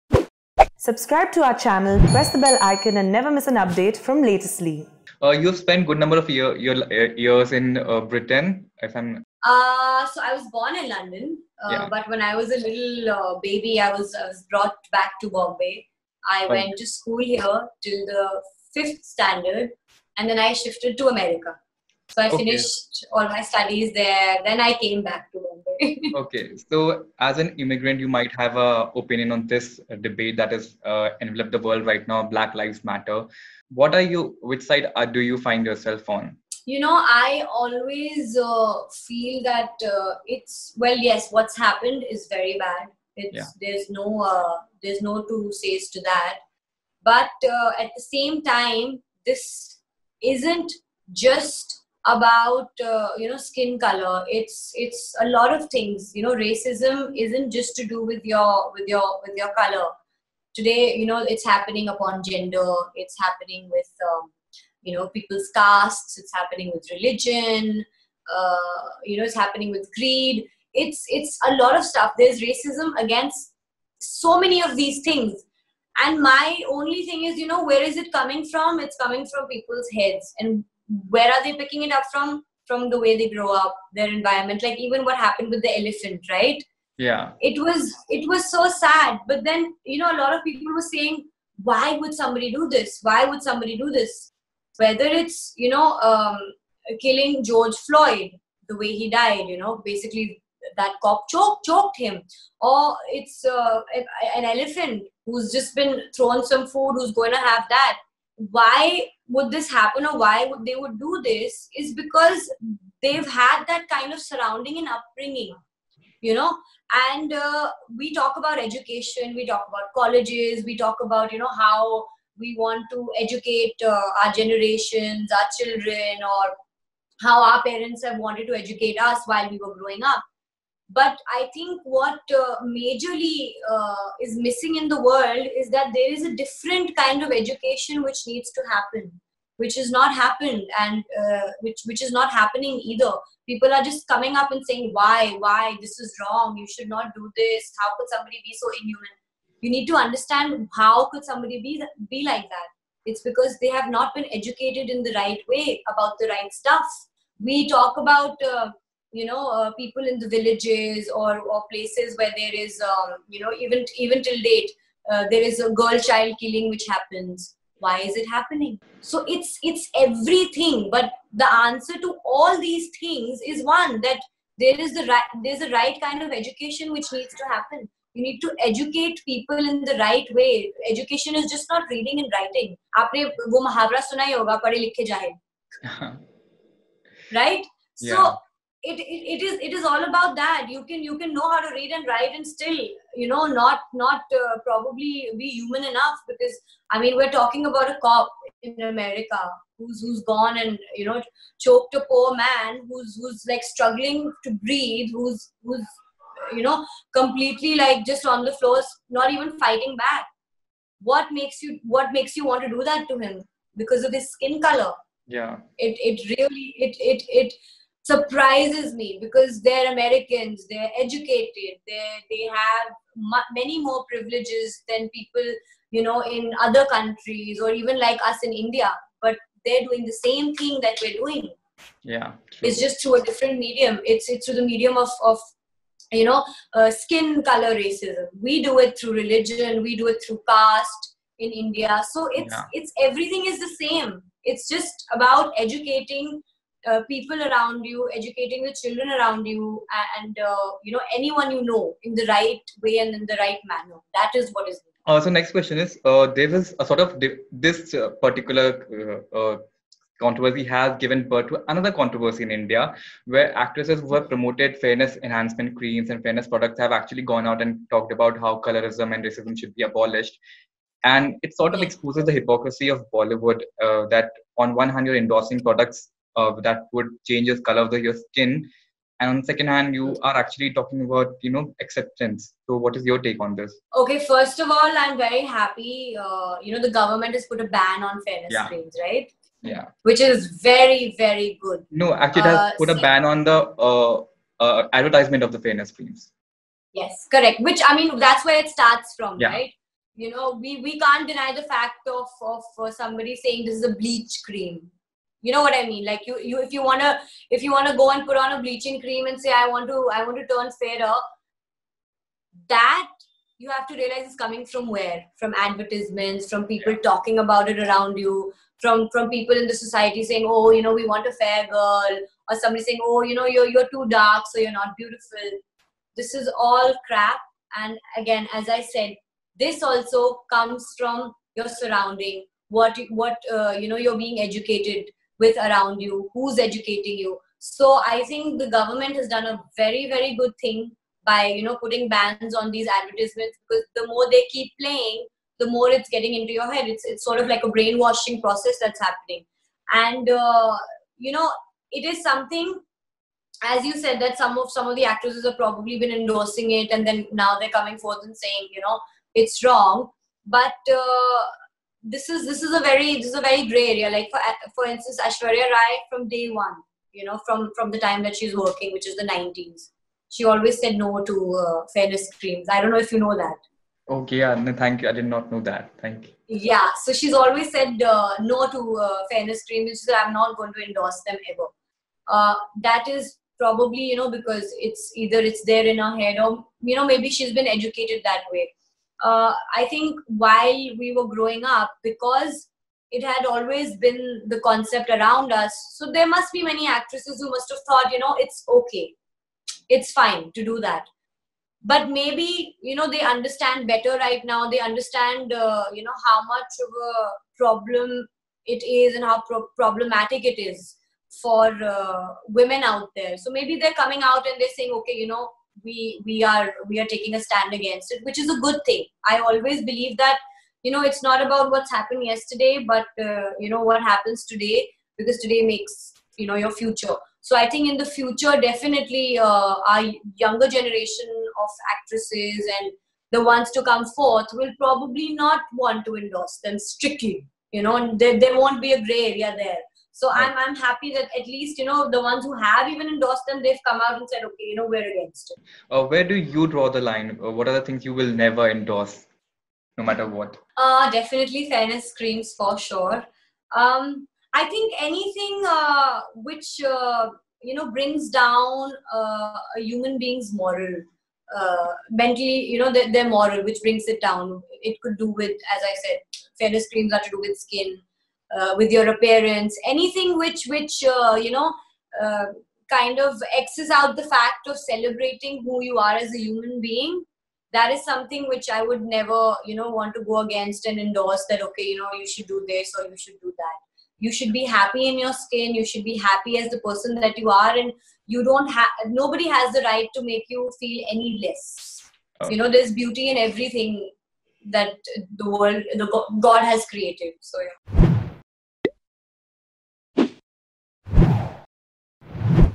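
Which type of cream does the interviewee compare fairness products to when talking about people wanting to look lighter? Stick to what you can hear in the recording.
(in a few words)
Bleach cream.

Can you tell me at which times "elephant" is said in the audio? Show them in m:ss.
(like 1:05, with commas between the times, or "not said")
1:25, 1:44.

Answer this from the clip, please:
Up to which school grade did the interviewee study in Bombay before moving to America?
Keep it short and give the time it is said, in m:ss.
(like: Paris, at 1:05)
Fifth standard, at 0:18.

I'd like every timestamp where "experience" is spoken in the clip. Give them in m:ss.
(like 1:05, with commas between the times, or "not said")
not said.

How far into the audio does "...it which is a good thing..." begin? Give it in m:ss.
6:58.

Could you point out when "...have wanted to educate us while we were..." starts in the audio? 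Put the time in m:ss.
2:08.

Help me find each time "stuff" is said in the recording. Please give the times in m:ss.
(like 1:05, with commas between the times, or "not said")
1:11, 2:36.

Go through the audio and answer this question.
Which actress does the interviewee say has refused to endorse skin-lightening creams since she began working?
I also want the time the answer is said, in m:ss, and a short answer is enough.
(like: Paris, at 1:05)
Aishwarya Rai, at 6:05.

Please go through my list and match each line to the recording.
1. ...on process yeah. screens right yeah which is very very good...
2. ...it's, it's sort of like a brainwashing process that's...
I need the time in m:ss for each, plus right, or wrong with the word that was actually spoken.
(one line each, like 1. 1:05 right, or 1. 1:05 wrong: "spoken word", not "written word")
1. 4:48 wrong: "fairness", not "process"
2. 5:46 right.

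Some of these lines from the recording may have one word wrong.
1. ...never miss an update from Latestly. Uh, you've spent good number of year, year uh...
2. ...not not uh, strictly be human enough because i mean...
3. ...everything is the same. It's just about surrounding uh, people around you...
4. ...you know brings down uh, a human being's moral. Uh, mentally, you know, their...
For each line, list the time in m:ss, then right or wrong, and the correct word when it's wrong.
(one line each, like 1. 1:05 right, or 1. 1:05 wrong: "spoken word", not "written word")
1. 0:03 right
2. 3:13 wrong: "probably", not "strictly"
3. 4:03 wrong: "educating", not "surrounding"
4. 7:37 right.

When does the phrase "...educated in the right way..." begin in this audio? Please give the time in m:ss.
2:34.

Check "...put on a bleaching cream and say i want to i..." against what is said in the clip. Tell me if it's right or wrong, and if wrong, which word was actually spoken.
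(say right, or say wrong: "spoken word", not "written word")
right.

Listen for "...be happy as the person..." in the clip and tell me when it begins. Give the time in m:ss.
8:06.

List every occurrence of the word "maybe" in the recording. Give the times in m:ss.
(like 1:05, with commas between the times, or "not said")
6:27, 6:42, 6:53.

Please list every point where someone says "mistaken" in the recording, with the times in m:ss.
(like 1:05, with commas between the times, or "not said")
not said.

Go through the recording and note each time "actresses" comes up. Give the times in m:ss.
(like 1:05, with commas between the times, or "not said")
4:23, 5:55, 6:36, 7:11.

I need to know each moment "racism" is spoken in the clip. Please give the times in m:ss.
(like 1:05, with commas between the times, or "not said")
0:56, 1:12, 3:57, 4:29.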